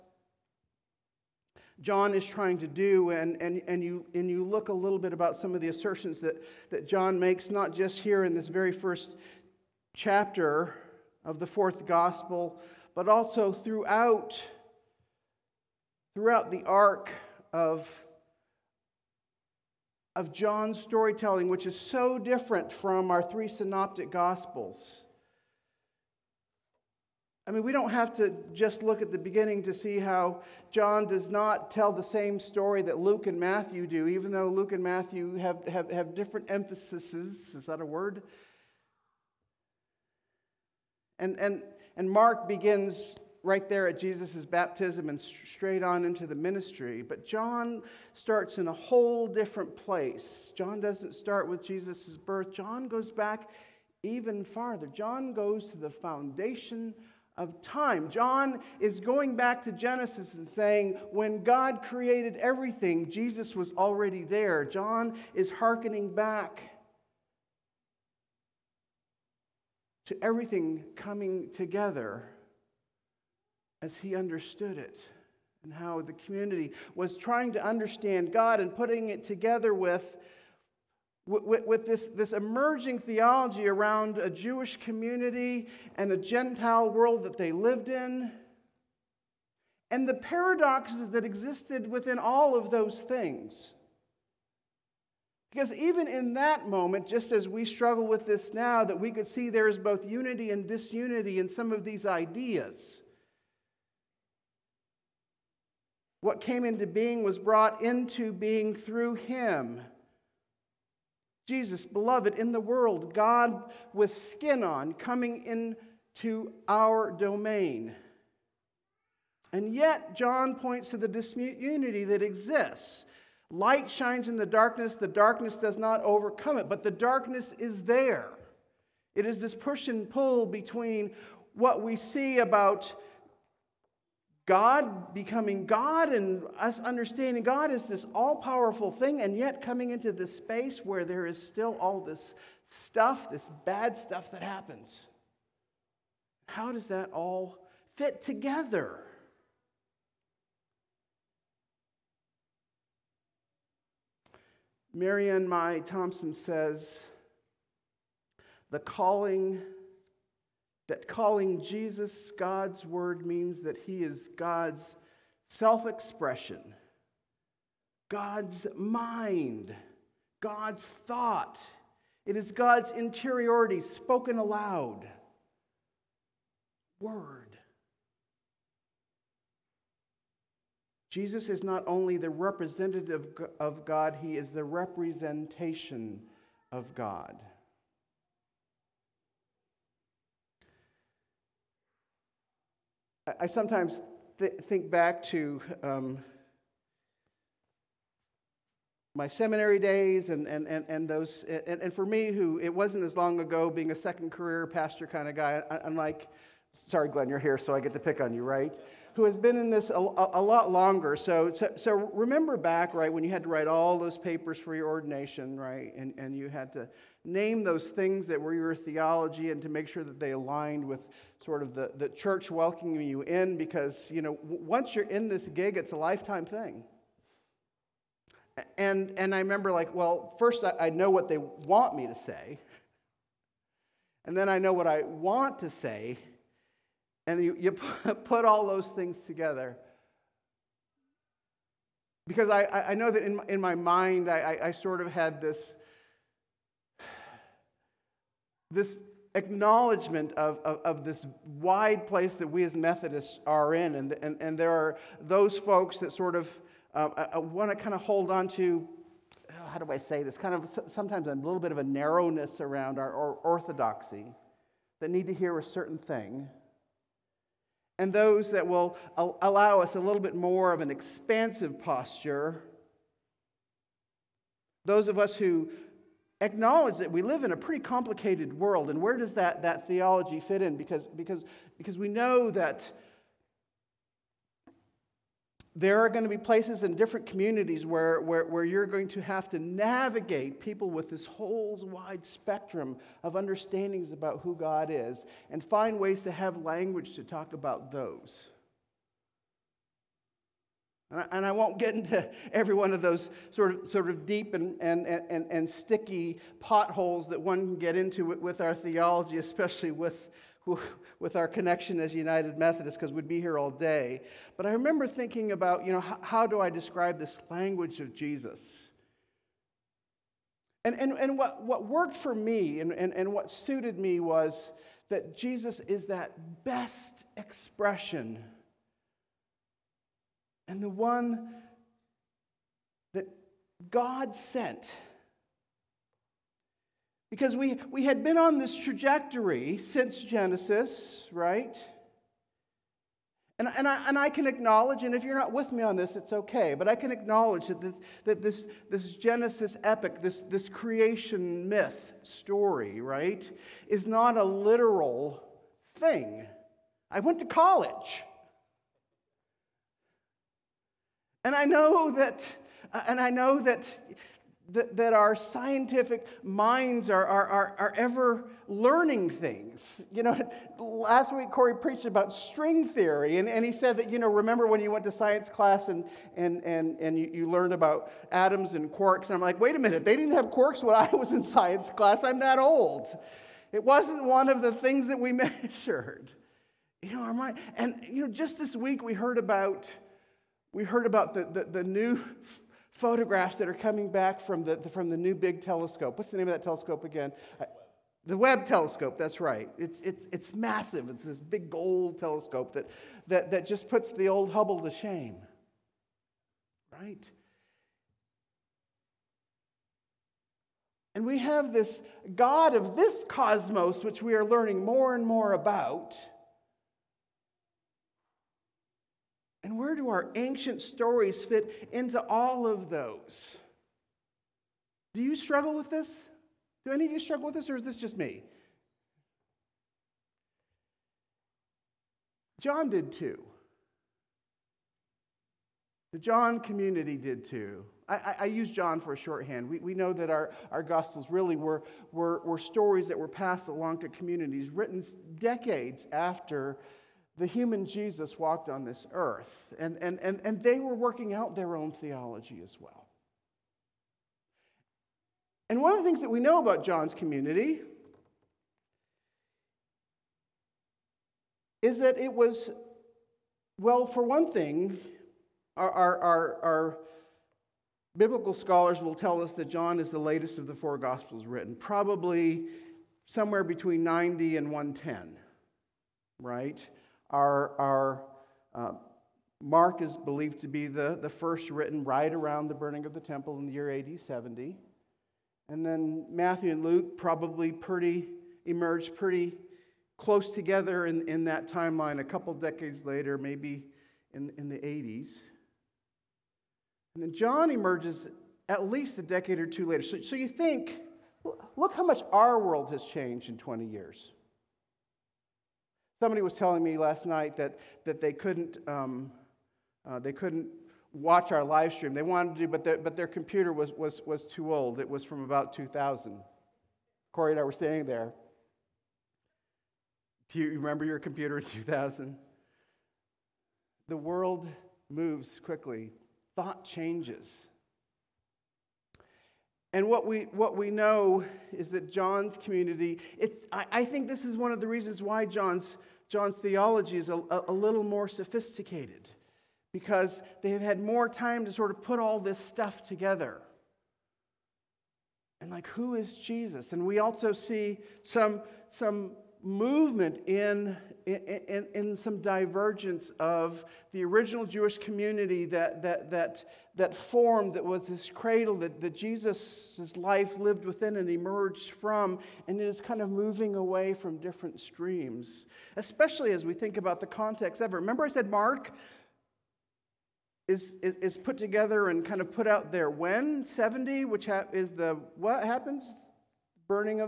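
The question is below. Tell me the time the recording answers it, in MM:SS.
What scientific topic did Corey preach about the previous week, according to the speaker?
06:12.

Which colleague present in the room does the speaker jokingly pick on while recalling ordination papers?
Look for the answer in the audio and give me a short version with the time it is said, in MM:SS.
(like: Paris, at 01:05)
Glenn, at 03:27.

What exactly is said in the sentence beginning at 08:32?
They wanted to, but their, but their computer was, was, was too old.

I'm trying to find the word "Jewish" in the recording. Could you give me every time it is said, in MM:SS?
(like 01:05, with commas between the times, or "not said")
01:24, 09:14.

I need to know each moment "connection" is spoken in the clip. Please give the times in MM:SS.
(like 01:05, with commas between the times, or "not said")
05:11.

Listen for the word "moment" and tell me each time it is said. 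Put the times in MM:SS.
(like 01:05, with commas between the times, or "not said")
01:36.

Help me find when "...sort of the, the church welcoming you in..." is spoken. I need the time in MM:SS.
03:41.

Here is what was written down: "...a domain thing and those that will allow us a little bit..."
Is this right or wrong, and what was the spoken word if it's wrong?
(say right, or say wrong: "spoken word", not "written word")
wrong: "certain", not "domain".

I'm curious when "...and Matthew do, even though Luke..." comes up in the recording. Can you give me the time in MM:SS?
00:33.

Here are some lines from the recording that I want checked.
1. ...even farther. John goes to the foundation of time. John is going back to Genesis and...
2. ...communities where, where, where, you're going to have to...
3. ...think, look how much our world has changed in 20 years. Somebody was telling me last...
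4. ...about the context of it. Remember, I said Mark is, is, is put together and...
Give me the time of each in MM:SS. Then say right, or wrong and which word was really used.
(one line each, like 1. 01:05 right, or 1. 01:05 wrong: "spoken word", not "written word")
1. 00:54 right
2. 04:47 right
3. 08:20 right
4. 09:26 right.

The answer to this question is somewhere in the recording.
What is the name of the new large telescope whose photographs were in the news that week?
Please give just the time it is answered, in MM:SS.
06:38.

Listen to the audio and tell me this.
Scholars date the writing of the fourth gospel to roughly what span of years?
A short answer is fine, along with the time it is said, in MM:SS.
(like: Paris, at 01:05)
90 and 110, at 07:54.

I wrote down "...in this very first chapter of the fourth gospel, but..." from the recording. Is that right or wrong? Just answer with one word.
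right.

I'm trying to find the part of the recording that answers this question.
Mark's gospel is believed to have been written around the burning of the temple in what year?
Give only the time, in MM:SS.
08:03.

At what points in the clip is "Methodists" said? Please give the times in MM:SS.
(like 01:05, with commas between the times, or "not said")
04:12, 05:12.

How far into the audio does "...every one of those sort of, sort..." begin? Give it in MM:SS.
05:02.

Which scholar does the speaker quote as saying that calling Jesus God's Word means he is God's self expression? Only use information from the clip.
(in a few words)
Marianne Meye Thompson.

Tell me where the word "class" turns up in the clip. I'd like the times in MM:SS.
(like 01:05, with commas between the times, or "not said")
06:15, 06:21.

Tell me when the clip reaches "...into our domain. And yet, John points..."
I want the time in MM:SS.
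01:55.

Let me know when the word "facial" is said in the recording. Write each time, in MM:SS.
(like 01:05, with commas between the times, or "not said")
not said.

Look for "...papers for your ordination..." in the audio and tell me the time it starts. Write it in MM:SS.
03:34.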